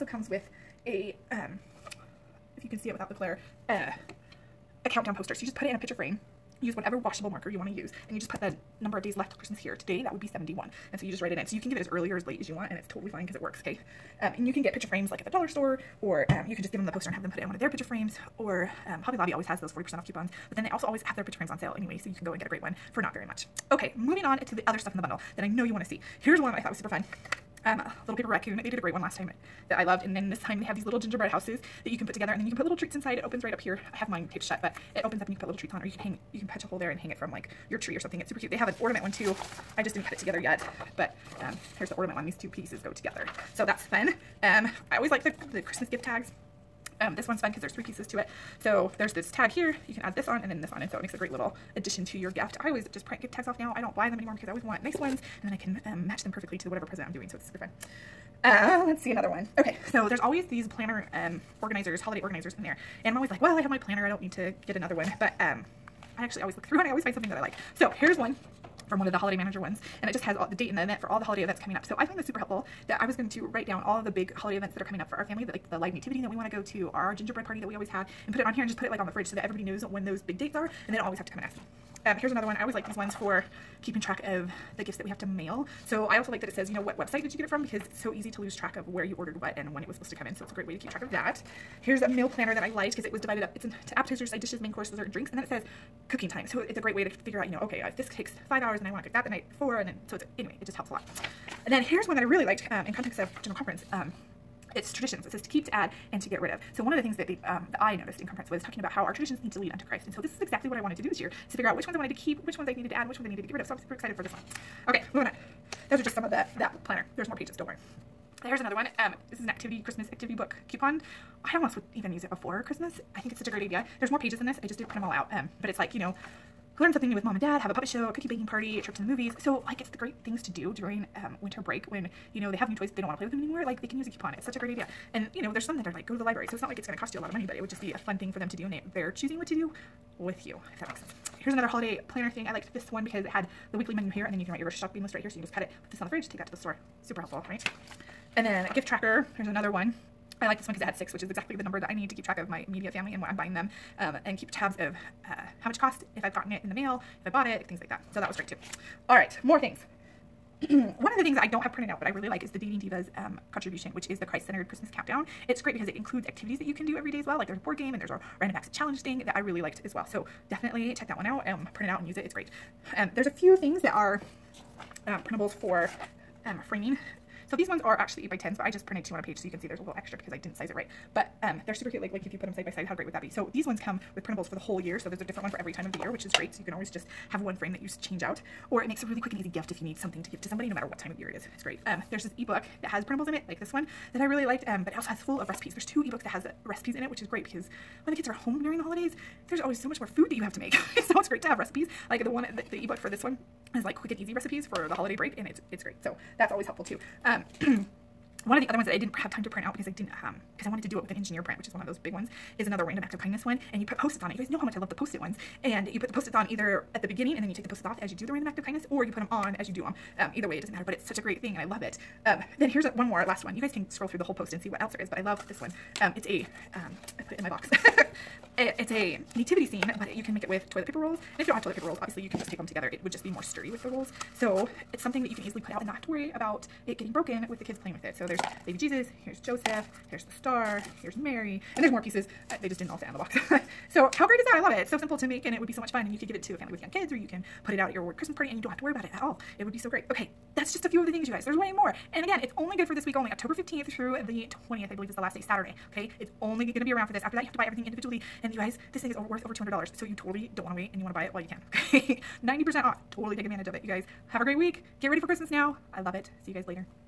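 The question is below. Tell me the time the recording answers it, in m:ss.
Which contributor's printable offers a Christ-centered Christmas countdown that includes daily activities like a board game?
2:42.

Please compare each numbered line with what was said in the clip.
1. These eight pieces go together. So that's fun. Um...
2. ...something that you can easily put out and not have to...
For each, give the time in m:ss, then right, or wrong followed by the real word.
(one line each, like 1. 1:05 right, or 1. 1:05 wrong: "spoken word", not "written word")
1. 0:42 wrong: "two", not "eight"
2. 3:55 right.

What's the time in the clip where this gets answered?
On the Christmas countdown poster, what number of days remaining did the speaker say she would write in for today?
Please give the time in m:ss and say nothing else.
0:10.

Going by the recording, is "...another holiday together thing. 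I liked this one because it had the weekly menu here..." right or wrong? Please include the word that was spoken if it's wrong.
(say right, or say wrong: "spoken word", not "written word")
wrong: "planner", not "together".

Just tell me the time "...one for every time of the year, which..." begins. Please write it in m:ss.
3:05.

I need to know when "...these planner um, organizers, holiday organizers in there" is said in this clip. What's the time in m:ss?
1:00.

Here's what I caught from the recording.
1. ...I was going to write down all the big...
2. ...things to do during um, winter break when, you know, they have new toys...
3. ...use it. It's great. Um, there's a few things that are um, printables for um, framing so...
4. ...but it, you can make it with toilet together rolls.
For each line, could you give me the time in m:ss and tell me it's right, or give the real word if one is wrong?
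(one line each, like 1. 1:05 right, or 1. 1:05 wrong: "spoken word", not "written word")
1. 1:13 right
2. 2:10 right
3. 2:52 right
4. 3:49 wrong: "paper", not "together".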